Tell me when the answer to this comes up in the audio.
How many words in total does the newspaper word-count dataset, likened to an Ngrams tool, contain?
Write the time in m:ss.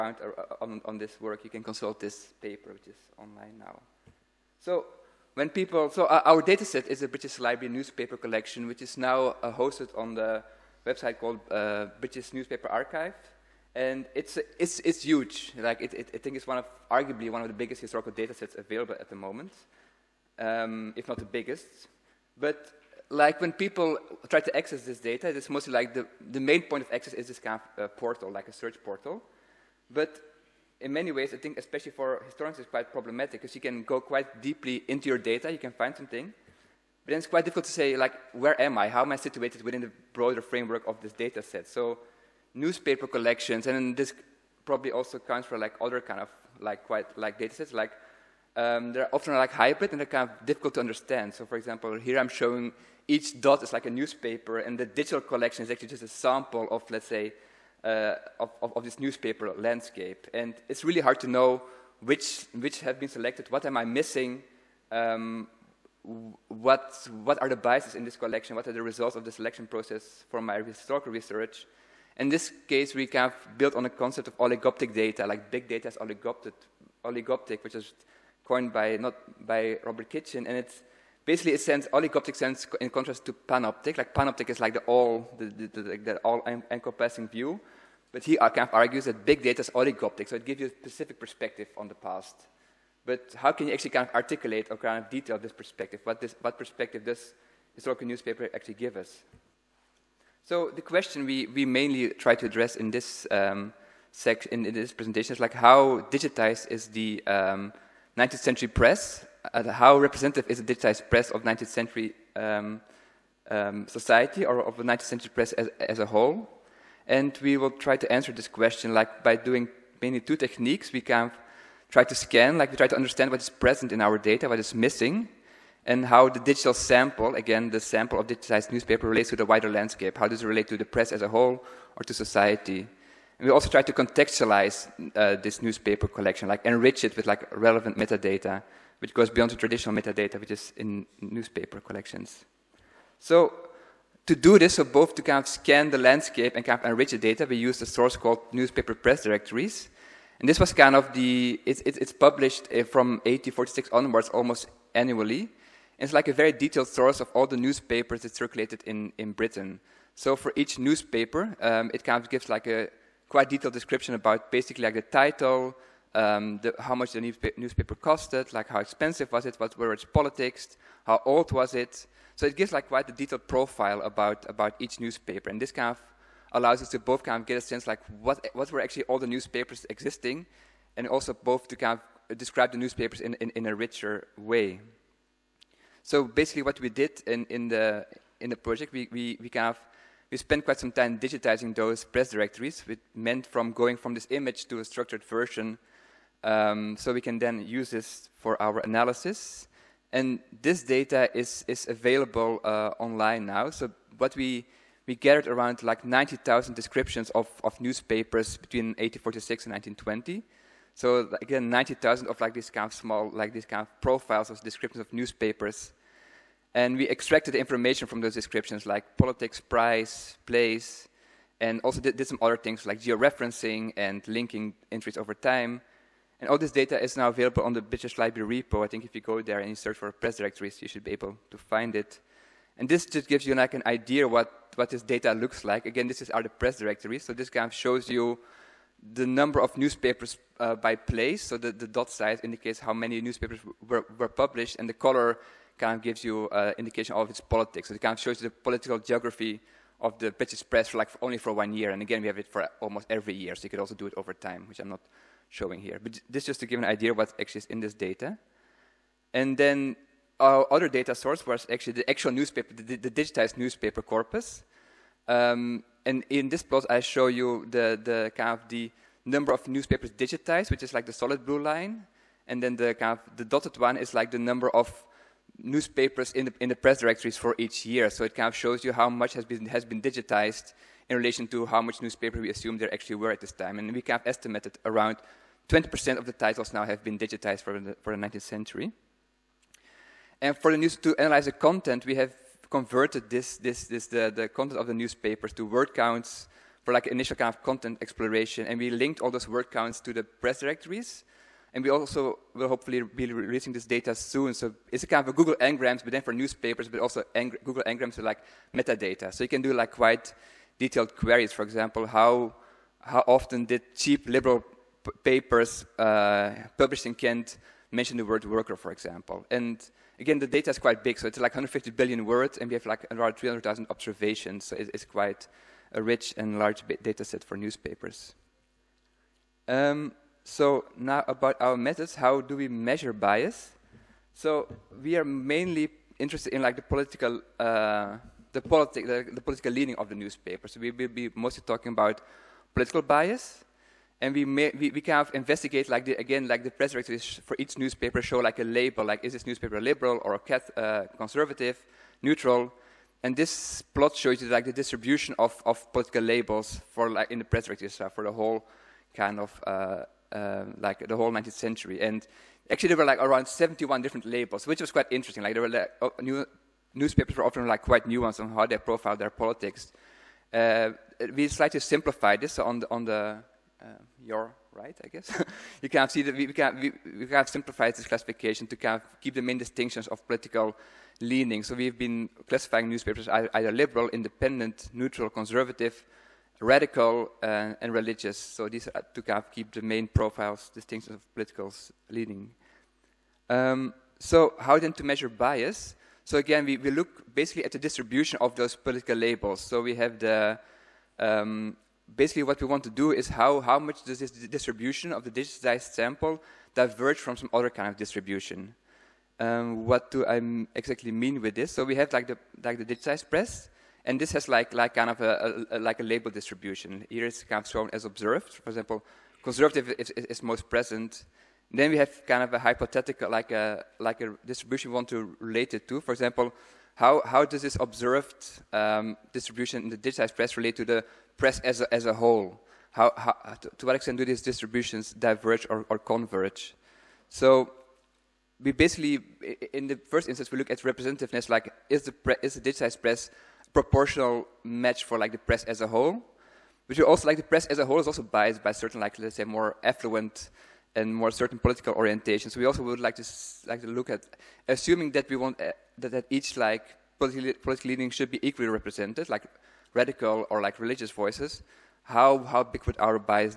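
5:21.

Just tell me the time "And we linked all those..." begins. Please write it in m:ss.
4:58.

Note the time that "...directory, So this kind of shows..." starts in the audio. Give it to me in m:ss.
3:56.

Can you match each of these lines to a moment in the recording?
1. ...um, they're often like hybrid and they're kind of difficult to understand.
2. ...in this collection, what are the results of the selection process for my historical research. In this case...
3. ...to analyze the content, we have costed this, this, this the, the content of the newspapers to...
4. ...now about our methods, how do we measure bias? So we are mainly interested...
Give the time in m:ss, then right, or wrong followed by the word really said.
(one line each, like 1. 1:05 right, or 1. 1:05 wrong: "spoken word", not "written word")
1. 0:48 right
2. 1:07 right
3. 4:50 wrong: "converted", not "costed"
4. 5:30 right.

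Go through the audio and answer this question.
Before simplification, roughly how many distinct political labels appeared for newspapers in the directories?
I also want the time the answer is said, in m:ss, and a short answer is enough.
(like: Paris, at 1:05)
71, at 6:03.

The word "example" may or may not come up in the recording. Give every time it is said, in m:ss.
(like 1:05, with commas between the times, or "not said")
0:51, 5:11, 5:18, 6:58, 7:06.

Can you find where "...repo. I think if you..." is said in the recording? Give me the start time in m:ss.
3:48.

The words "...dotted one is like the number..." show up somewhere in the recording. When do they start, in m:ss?
4:33.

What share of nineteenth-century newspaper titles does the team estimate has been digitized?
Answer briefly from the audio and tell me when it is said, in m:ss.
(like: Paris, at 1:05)
20%, at 4:45.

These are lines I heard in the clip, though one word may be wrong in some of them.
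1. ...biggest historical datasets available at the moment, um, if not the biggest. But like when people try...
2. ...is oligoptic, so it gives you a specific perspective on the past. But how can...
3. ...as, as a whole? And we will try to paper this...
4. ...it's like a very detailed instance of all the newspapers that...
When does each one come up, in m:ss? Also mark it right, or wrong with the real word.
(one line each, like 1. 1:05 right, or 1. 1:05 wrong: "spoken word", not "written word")
1. 0:17 right
2. 1:29 right
3. 1:55 wrong: "answer", not "paper"
4. 2:36 wrong: "source", not "instance".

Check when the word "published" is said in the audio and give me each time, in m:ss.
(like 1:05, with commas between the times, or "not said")
2:32, 4:04, 5:16.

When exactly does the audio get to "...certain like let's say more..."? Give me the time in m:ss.
7:28.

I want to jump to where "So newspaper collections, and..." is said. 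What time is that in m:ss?
0:41.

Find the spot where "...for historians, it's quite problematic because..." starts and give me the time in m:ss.
0:31.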